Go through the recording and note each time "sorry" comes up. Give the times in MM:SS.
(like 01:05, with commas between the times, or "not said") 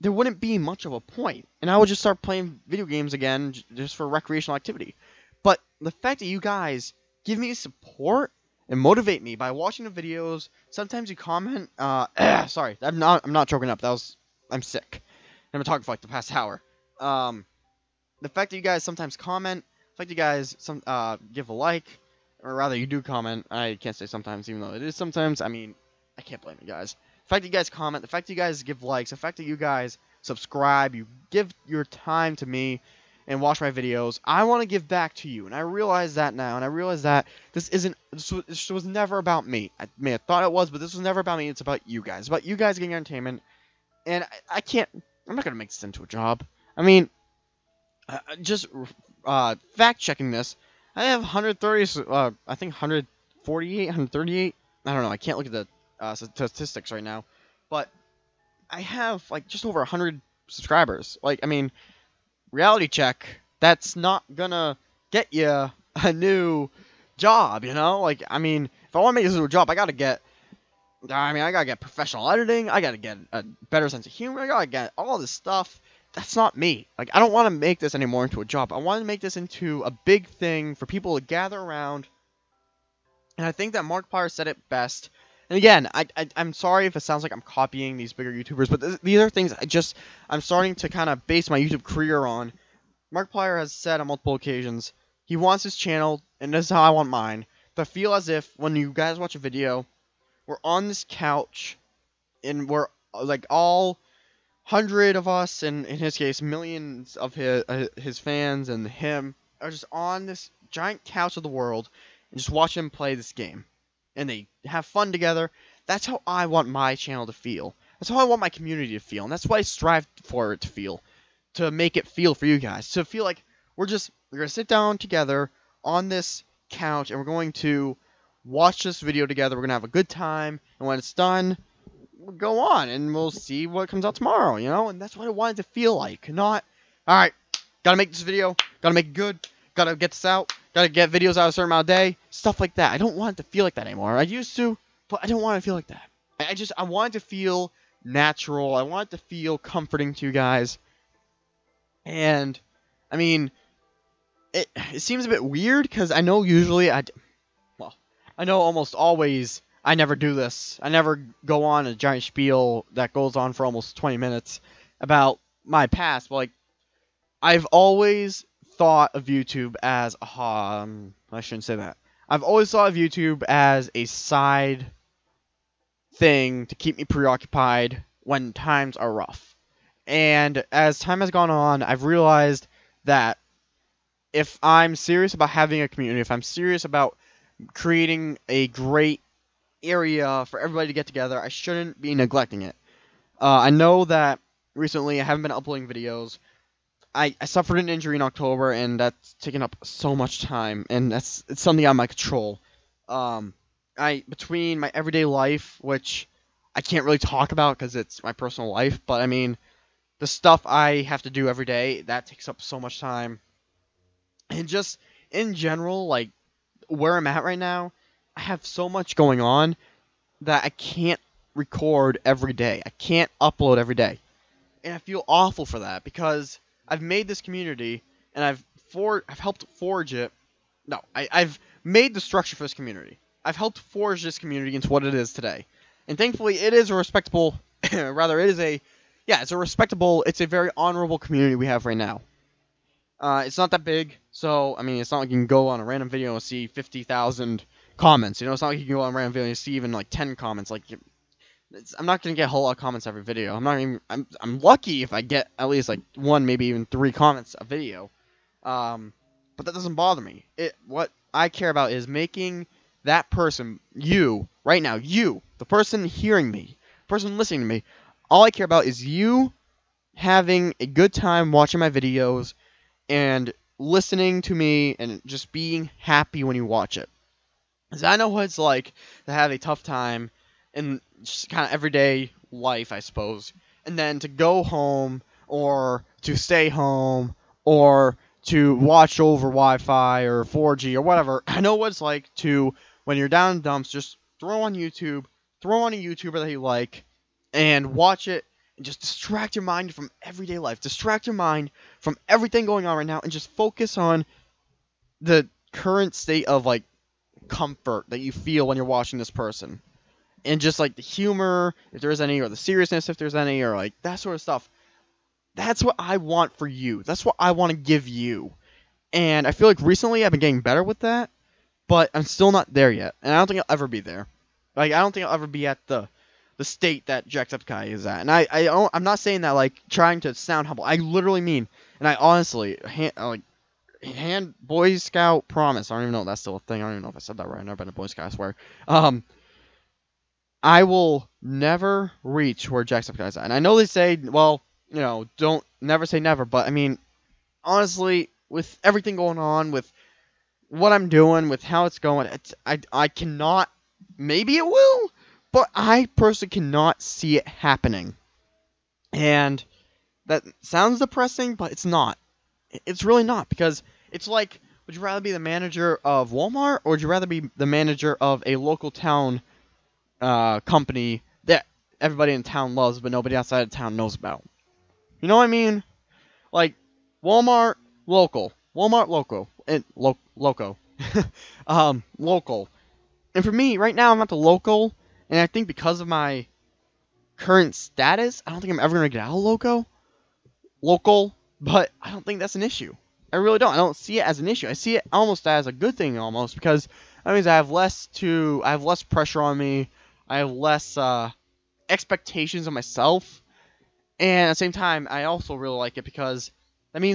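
00:12, 01:26.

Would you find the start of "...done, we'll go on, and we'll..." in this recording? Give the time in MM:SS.
02:11.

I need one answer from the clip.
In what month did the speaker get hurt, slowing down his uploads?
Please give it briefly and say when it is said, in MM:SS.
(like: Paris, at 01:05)
October, at 03:18.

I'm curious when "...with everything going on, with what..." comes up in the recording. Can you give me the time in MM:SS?
05:48.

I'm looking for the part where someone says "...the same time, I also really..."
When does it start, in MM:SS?
06:44.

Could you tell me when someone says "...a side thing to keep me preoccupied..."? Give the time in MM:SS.
02:53.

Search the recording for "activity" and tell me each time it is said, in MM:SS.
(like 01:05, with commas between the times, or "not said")
00:04.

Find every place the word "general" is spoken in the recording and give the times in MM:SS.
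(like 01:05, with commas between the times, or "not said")
03:35.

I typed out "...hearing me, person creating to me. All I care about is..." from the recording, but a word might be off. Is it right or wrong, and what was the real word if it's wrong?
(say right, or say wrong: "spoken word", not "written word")
wrong: "listening", not "creating".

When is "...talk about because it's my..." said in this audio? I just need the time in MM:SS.
03:27.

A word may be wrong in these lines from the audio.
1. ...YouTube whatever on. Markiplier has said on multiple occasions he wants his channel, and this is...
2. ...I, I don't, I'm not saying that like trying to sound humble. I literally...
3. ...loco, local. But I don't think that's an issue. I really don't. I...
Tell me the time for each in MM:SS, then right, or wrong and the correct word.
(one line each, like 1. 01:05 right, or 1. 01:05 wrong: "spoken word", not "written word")
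1. 01:31 wrong: "career", not "whatever"
2. 05:28 right
3. 06:29 right.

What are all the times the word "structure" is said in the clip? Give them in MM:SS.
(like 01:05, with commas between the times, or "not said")
03:52.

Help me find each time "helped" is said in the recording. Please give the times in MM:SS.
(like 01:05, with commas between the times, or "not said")
03:49, 03:53.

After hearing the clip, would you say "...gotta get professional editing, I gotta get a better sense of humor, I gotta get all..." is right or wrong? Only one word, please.
right.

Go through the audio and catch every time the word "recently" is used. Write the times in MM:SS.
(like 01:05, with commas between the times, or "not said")
03:14, 05:19.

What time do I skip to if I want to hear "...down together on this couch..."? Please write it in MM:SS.
02:04.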